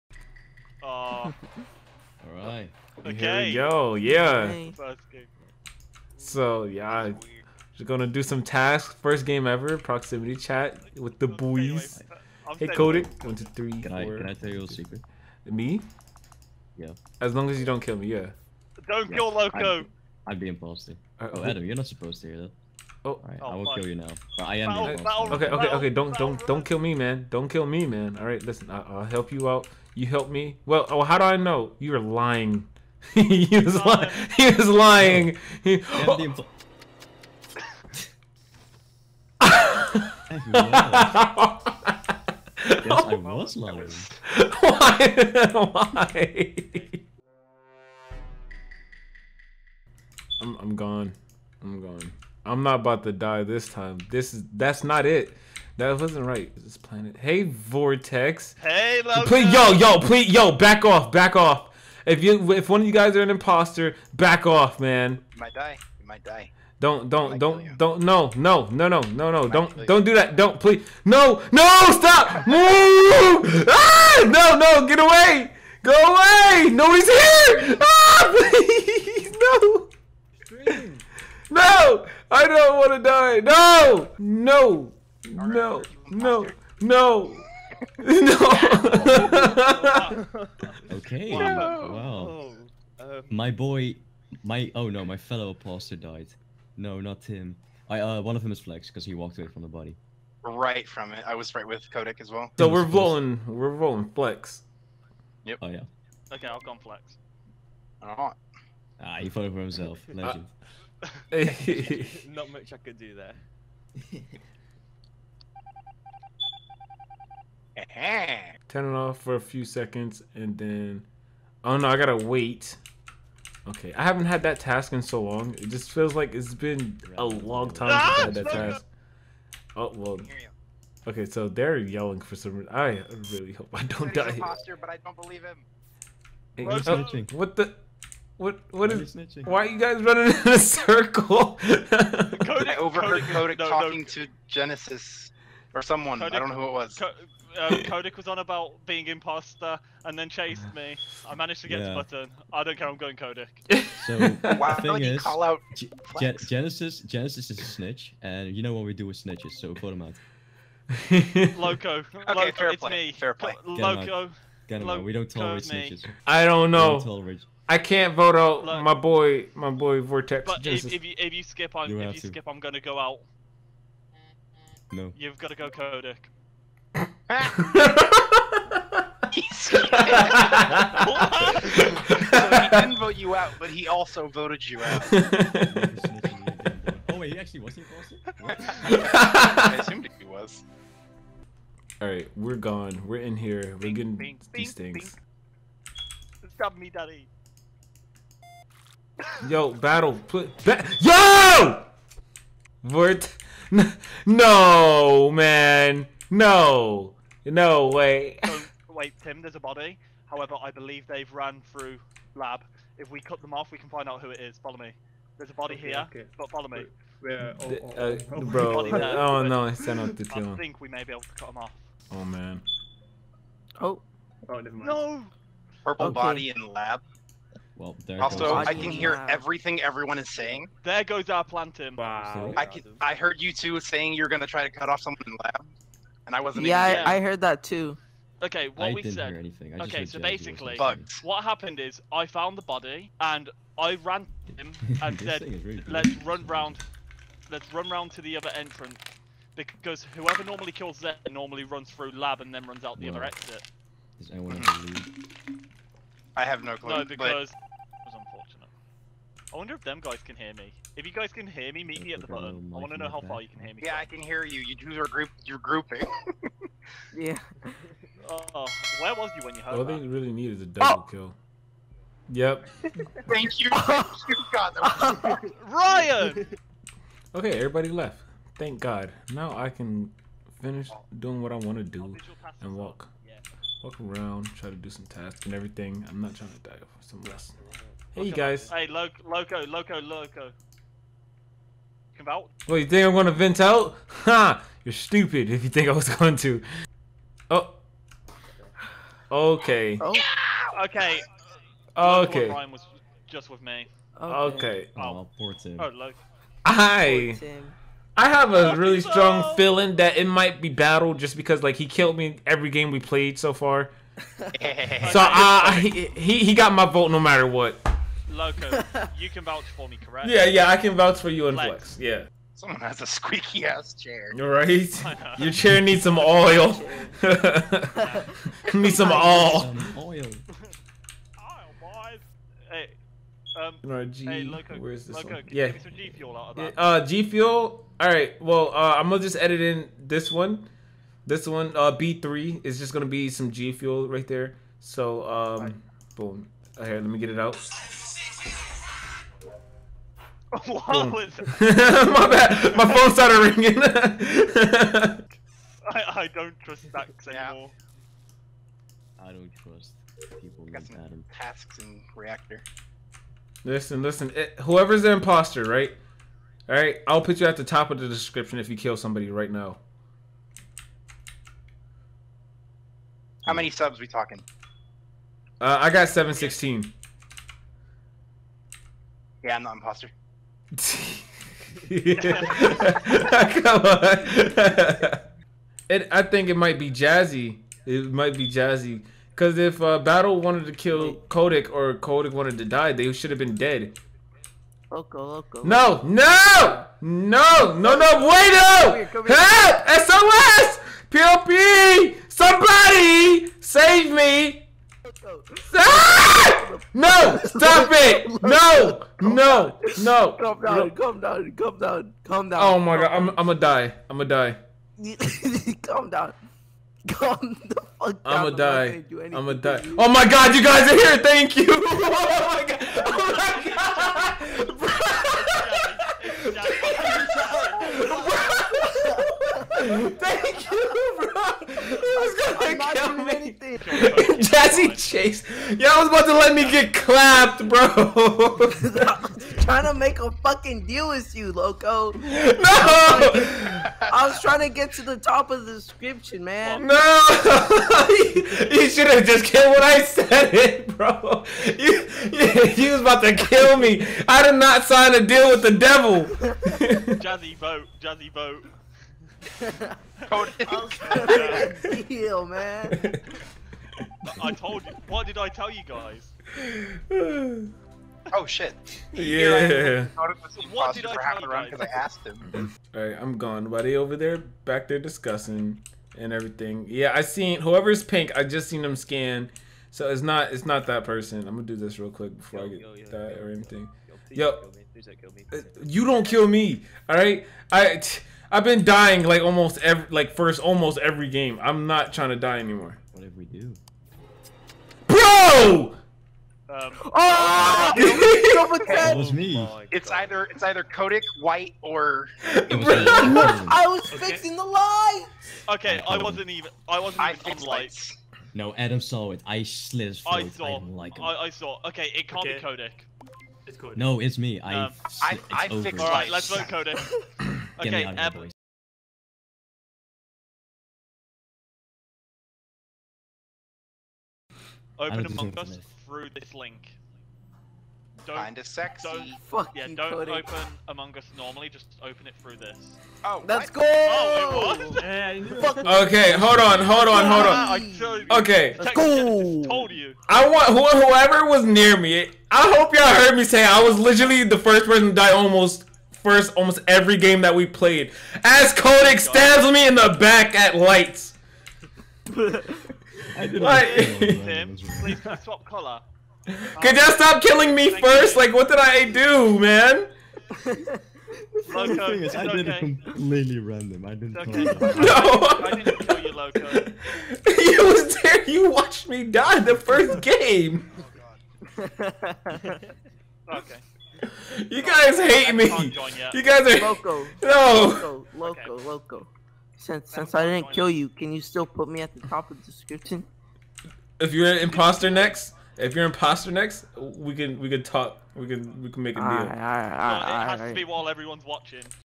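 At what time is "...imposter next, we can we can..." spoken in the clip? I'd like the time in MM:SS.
09:46.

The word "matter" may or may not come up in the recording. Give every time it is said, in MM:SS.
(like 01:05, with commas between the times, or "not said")
05:17.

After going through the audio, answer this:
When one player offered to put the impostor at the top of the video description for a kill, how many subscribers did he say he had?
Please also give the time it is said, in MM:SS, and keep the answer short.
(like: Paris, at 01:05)
716, at 06:16.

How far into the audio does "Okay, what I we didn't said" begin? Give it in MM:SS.
03:58.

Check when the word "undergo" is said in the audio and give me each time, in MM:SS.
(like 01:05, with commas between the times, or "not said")
not said.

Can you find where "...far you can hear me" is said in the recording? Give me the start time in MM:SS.
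04:23.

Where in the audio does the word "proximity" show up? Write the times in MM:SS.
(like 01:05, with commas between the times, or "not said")
00:09.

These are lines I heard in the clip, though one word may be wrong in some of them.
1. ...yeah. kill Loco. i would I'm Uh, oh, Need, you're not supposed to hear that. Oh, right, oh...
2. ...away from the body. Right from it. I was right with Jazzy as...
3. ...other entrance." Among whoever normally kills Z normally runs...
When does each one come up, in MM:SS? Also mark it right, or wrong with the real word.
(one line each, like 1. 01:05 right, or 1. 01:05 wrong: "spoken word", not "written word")
1. 00:19 wrong: "Adam", not "Need"
2. 01:39 wrong: "Kodak", not "Jazzy"
3. 04:08 wrong: "Because", not "Among".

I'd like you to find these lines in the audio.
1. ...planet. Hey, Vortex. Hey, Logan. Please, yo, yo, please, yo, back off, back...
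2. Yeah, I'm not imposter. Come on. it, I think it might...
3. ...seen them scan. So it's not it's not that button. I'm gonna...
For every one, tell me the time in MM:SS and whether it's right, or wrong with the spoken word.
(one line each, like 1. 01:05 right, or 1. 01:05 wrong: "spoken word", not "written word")
1. 00:56 right
2. 06:19 right
3. 07:58 wrong: "person", not "button".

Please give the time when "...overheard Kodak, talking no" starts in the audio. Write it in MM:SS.
02:22.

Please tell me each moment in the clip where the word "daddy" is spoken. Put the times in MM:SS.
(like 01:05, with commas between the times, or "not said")
03:16.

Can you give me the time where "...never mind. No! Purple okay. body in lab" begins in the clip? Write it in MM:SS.
03:44.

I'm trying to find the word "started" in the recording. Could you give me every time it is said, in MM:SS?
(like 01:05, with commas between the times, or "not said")
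05:53.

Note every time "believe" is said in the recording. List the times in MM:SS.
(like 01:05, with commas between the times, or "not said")
02:15, 03:30.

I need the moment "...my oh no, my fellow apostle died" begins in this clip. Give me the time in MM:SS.
01:34.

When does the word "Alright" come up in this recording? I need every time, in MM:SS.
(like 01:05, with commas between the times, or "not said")
01:48, 03:12, 05:38.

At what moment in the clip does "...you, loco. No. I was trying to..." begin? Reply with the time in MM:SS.
07:21.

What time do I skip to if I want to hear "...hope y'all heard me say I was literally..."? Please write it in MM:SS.
09:02.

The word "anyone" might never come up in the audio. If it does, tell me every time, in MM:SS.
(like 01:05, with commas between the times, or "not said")
04:14.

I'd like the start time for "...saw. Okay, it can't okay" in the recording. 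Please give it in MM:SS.
08:31.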